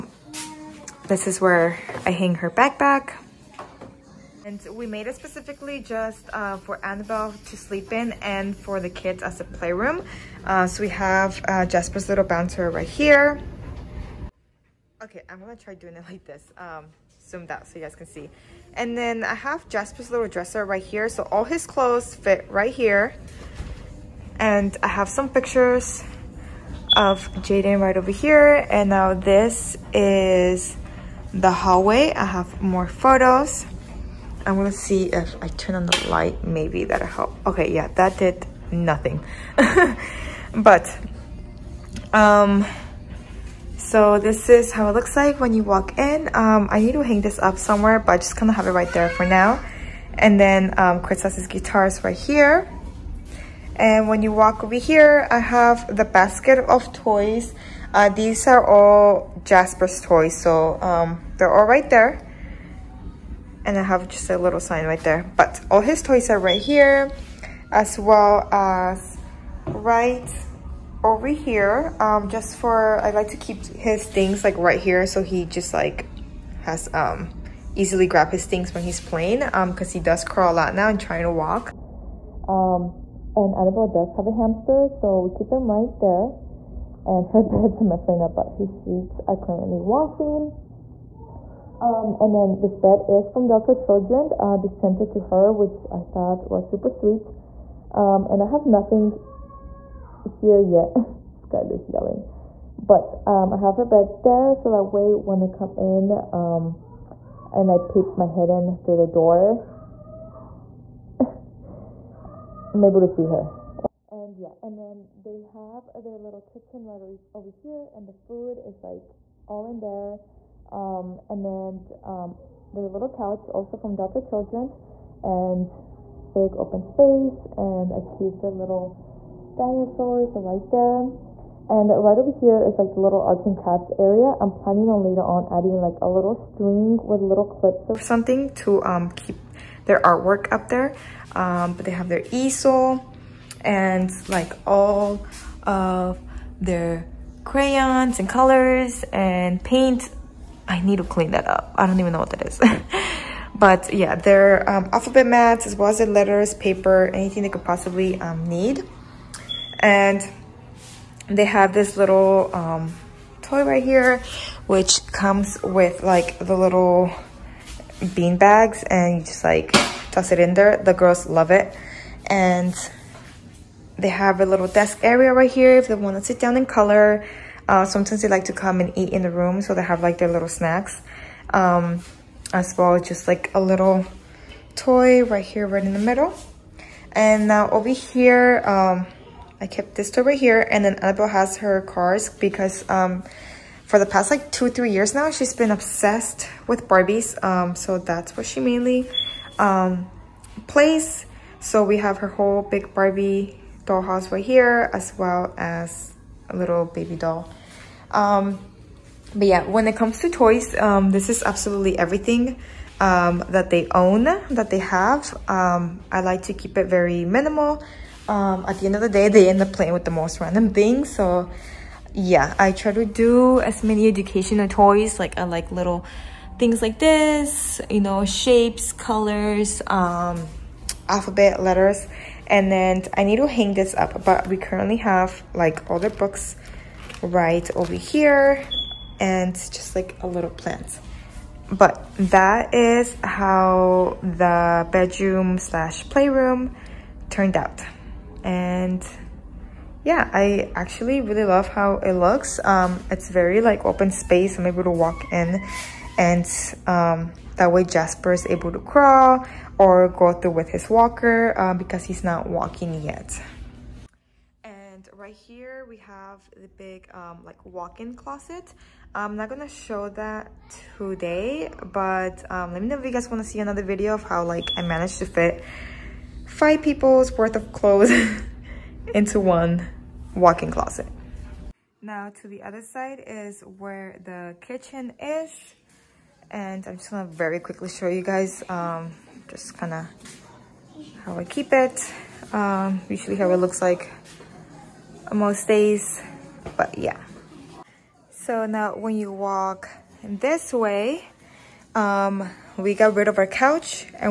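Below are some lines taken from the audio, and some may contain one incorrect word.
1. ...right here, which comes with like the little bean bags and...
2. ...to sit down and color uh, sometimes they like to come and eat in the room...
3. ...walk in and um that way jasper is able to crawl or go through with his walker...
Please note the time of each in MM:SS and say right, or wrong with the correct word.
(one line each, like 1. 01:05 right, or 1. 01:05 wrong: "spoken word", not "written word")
1. 02:43 right
2. 02:56 right
3. 04:14 right.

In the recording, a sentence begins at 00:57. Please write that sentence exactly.
Uh, these are all Jasper's toys, so um, they're all right there and I have just a little sign right there.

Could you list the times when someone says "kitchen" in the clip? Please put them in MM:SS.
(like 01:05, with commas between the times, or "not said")
01:56, 04:44.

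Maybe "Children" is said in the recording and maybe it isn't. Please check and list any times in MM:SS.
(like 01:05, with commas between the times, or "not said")
01:33, 02:04.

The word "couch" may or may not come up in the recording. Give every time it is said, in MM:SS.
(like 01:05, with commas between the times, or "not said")
02:03, 05:03.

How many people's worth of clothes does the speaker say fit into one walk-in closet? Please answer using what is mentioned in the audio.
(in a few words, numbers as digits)
5.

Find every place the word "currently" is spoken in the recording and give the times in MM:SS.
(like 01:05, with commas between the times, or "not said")
01:29, 03:54.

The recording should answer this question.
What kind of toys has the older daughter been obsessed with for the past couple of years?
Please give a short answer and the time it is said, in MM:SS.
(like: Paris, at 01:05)
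Barbies, at 03:16.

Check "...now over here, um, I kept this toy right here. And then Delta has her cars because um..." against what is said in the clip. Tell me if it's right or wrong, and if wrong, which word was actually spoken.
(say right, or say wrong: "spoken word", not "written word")
wrong: "Annabelle", not "Delta".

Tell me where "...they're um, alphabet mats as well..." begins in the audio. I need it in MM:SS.
02:34.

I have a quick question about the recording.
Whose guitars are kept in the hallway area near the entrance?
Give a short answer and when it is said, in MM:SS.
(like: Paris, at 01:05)
Chris, at 00:51.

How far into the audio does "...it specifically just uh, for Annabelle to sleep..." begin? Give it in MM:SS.
00:05.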